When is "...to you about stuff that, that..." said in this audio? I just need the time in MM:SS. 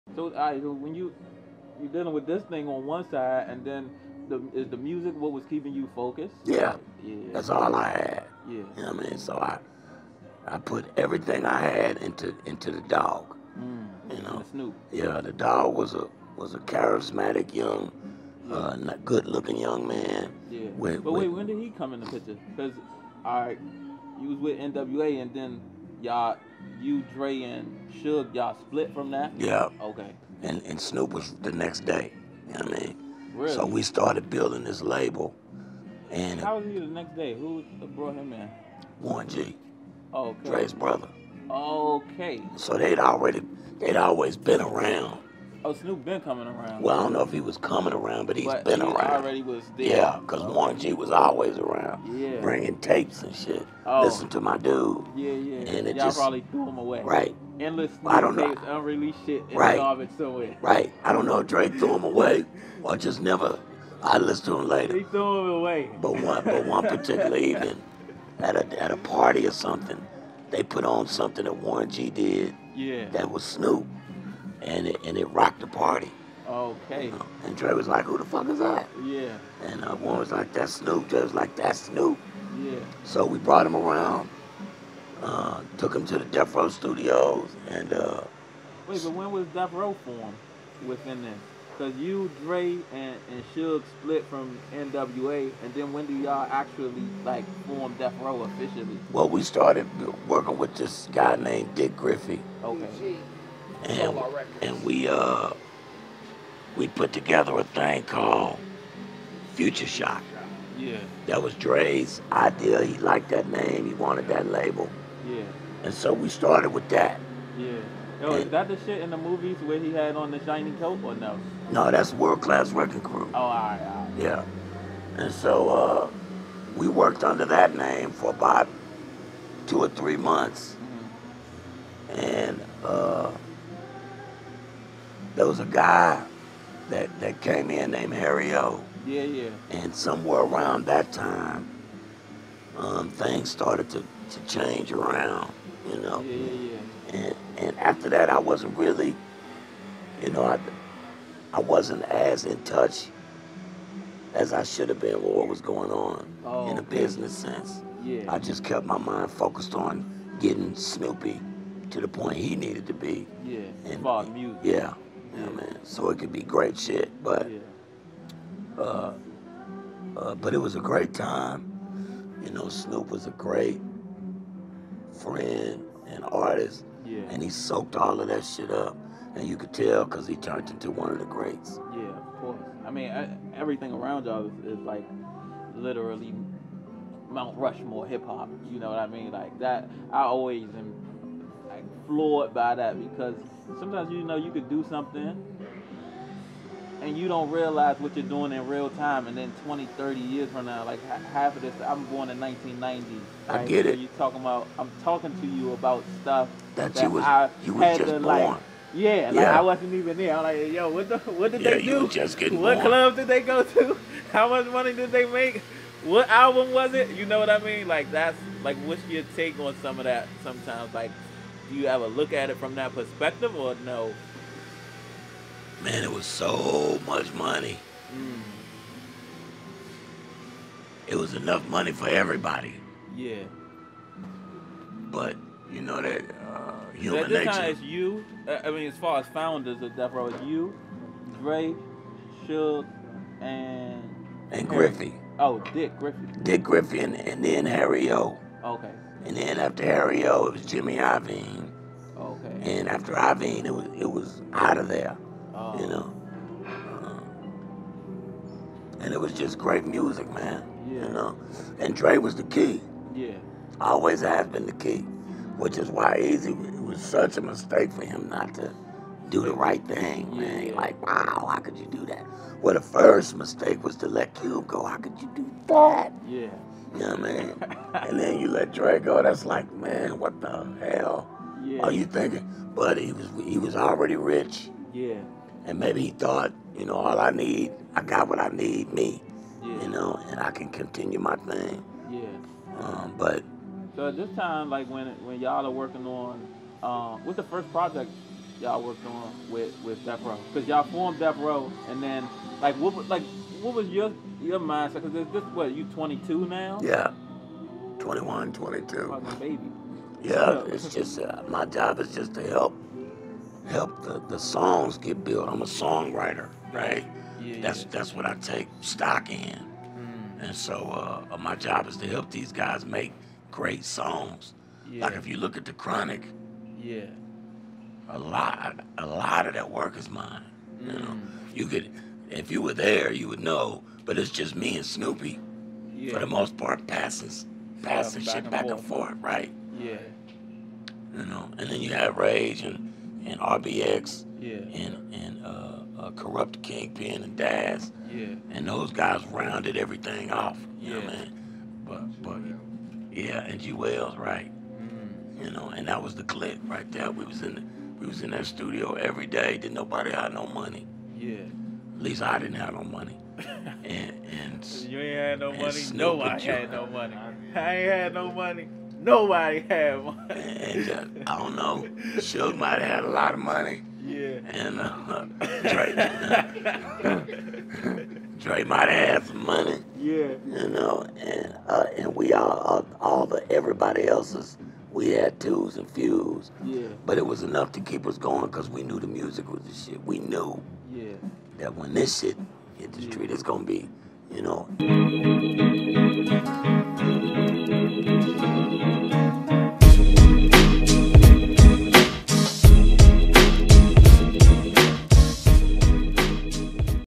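03:25.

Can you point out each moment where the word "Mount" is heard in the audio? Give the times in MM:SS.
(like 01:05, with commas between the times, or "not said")
03:07.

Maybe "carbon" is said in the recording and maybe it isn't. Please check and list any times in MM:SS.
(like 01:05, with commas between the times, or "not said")
not said.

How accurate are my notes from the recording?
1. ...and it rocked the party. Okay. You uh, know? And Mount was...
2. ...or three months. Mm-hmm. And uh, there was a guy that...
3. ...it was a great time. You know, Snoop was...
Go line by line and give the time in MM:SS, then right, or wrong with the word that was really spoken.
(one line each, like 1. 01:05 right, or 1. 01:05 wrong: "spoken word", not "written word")
1. 01:15 wrong: "Dre", not "Mount"
2. 02:09 right
3. 02:50 right.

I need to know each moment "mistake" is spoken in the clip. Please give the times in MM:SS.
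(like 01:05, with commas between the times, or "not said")
04:27, 04:33.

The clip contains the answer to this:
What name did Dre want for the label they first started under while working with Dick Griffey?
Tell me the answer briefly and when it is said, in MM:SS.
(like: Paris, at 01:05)
Future Shock, at 01:49.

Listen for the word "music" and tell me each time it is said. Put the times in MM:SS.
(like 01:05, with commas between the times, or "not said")
00:04, 02:44, 04:19, 06:29.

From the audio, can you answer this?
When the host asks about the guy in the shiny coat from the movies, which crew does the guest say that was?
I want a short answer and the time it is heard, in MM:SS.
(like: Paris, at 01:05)
World Class Wrecking Crew, at 02:02.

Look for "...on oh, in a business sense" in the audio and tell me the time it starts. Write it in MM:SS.
02:35.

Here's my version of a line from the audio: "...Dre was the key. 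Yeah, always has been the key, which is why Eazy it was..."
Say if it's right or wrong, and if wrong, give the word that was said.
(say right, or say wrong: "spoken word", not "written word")
right.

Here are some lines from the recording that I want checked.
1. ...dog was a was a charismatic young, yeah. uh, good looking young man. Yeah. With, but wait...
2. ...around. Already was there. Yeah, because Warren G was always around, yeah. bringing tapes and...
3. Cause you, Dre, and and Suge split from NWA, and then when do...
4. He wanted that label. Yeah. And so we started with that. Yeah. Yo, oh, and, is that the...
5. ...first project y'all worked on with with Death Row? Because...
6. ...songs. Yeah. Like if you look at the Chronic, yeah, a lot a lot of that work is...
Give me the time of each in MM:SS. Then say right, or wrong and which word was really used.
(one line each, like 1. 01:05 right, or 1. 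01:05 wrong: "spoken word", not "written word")
1. 00:15 right
2. 00:48 right
3. 01:31 right
4. 01:53 right
5. 04:57 right
6. 05:23 right.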